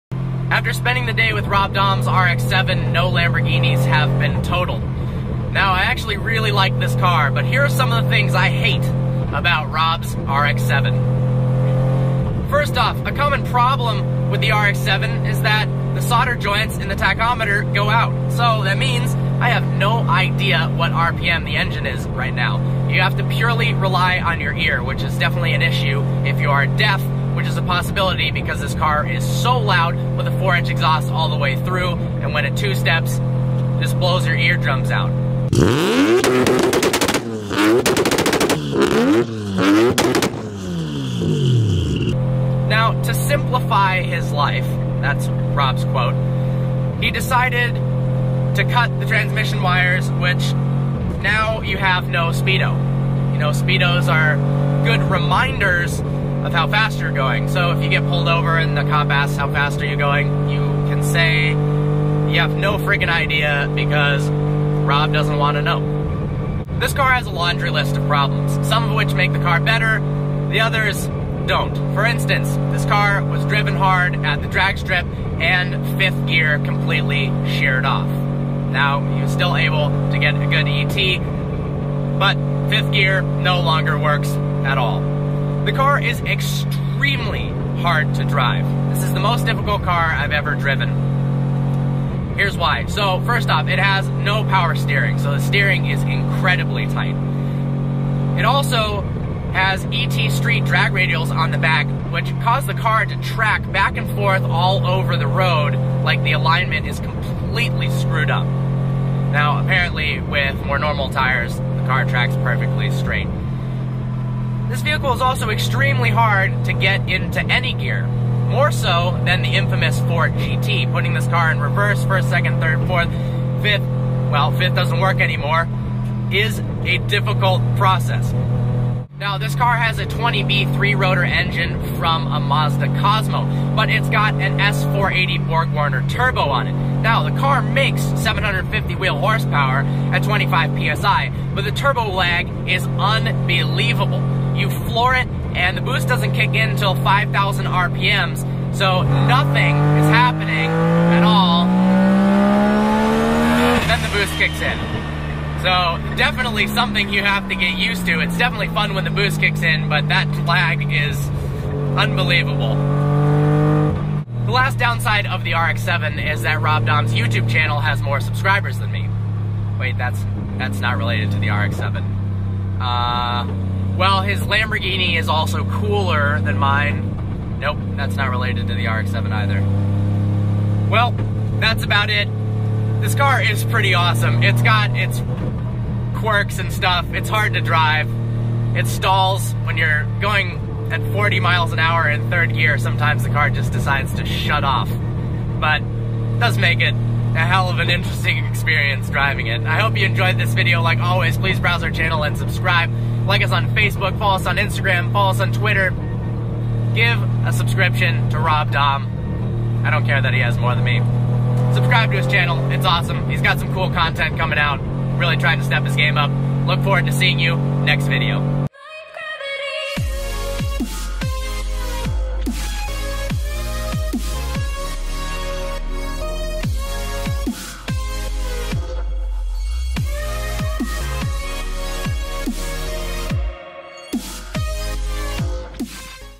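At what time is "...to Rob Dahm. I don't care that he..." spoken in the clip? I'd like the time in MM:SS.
03:28.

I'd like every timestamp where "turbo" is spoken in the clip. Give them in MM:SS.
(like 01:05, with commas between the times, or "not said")
02:16, 02:21.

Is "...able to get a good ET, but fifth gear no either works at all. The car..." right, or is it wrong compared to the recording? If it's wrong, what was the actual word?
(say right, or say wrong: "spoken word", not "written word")
wrong: "longer", not "either".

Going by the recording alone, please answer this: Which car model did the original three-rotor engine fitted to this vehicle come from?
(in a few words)
Mazda Cosmo.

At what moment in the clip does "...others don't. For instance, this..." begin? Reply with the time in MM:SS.
01:10.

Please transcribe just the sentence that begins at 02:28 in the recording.
So nothing is happening at all.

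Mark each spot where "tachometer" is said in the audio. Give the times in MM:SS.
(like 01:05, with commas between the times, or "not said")
00:16.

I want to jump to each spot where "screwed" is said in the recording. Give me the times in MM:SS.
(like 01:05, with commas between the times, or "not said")
01:47.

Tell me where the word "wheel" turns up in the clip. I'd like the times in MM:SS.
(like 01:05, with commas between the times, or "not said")
02:18.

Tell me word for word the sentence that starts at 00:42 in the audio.
Now, to simplify his life, that's Rob's quote, he decided to cut the transmission wires, which now you have no Speedo.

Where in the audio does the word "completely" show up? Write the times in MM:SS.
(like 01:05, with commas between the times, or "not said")
01:16, 01:46.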